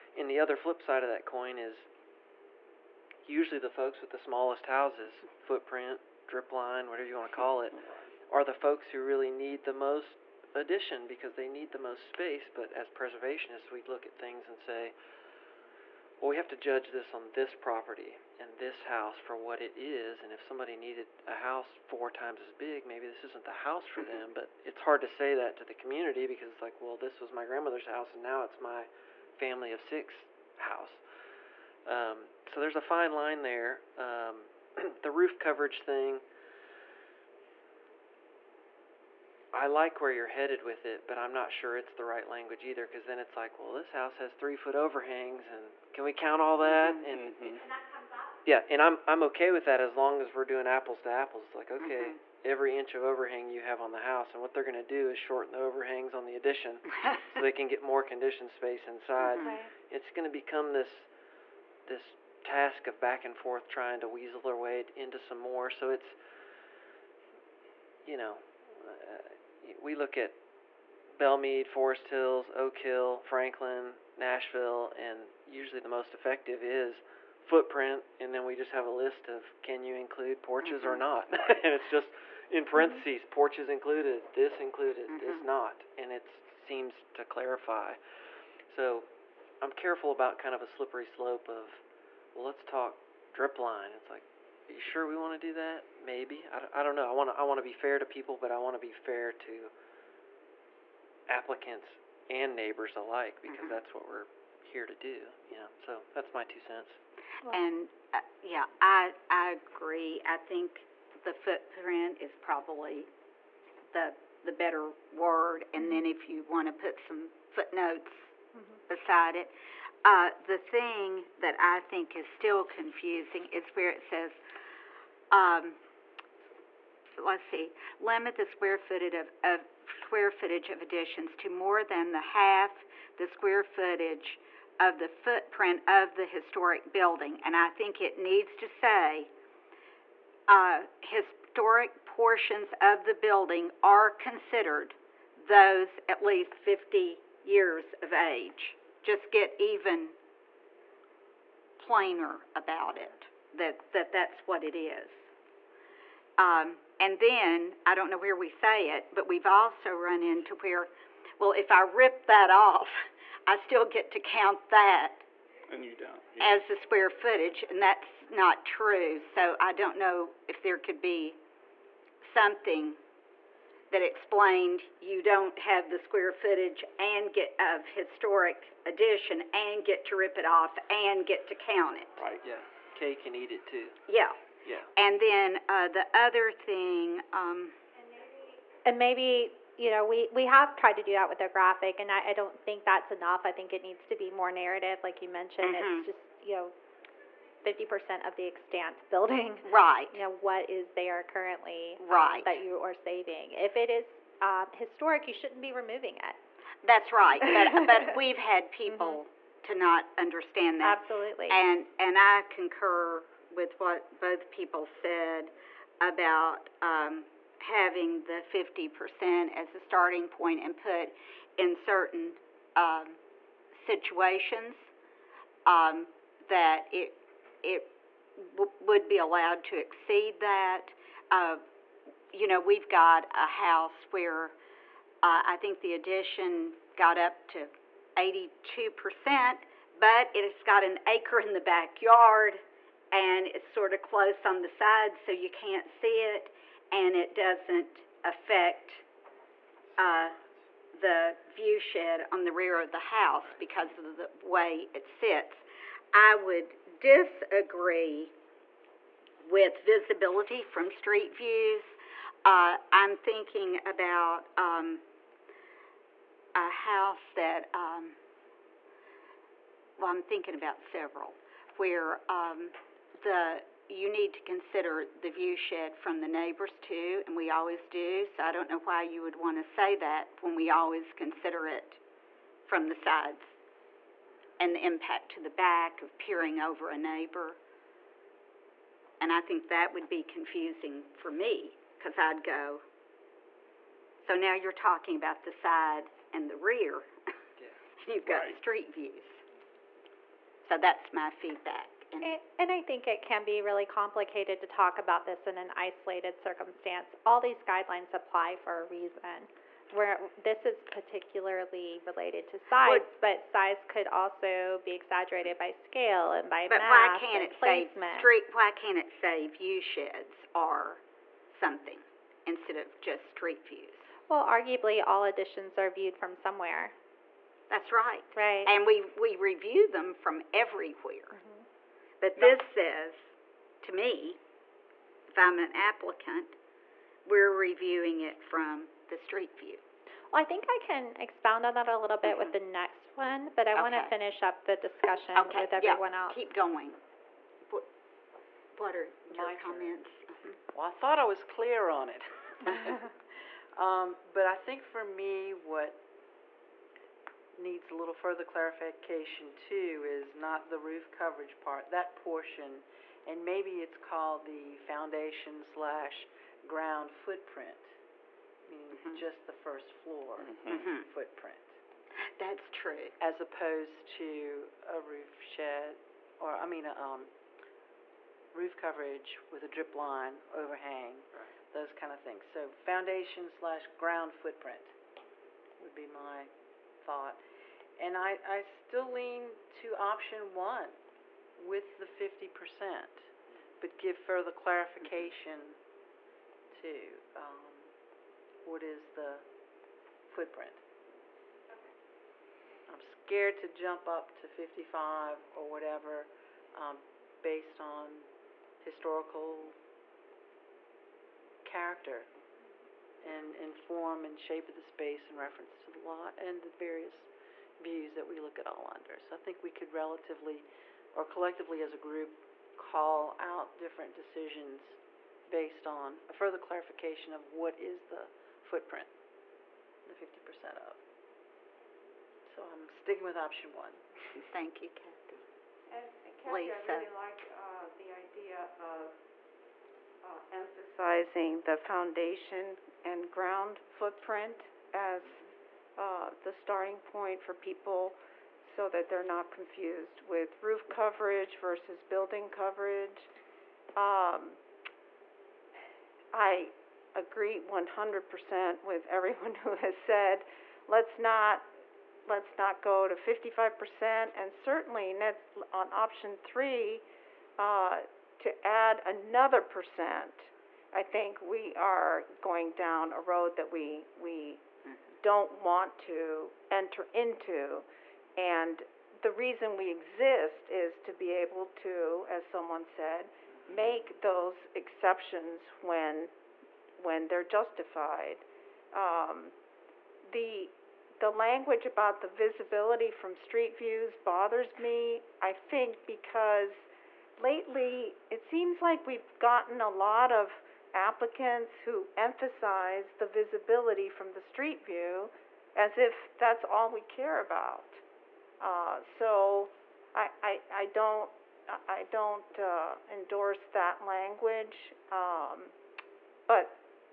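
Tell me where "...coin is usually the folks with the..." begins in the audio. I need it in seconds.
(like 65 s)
1 s.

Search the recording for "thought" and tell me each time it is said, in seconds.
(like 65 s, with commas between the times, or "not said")
351 s, 387 s.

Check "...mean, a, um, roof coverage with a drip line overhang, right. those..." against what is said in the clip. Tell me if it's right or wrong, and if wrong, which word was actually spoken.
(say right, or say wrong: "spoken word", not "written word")
right.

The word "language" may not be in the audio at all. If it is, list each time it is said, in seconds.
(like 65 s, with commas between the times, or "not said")
42 s, 491 s, 514 s.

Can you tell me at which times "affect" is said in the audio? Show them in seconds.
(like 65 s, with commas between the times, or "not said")
248 s.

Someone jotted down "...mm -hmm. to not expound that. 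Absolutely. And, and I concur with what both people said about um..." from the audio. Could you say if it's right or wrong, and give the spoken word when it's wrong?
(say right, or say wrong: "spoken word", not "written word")
wrong: "understand", not "expound".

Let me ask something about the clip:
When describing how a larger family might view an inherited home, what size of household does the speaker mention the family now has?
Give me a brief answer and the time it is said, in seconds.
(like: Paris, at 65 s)
family of six, at 29 s.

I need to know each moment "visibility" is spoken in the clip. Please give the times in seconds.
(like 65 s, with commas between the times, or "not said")
259 s, 492 s, 503 s.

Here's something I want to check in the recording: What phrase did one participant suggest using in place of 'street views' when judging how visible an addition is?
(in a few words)
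view sheds.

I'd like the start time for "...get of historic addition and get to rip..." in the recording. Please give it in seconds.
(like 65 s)
177 s.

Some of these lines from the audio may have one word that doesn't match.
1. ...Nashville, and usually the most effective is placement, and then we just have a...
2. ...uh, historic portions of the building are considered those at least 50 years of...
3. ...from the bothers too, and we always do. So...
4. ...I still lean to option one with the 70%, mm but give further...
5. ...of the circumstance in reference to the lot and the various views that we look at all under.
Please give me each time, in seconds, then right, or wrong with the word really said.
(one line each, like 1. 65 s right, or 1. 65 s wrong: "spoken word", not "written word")
1. 74 s wrong: "footprint", not "placement"
2. 140 s right
3. 275 s wrong: "neighbors", not "bothers"
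4. 388 s wrong: "50", not "70"
5. 414 s wrong: "space", not "circumstance".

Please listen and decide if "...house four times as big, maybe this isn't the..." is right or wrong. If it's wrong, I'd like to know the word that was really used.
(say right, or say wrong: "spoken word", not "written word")
right.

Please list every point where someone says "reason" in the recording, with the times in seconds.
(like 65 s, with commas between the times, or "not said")
308 s, 479 s.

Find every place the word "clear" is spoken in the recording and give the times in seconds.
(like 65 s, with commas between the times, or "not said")
351 s.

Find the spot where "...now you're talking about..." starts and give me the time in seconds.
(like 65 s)
294 s.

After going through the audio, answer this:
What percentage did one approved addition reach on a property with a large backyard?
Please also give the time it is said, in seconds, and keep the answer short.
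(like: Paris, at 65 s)
82%, at 238 s.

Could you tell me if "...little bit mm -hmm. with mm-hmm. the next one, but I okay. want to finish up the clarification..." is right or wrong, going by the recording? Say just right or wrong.
wrong.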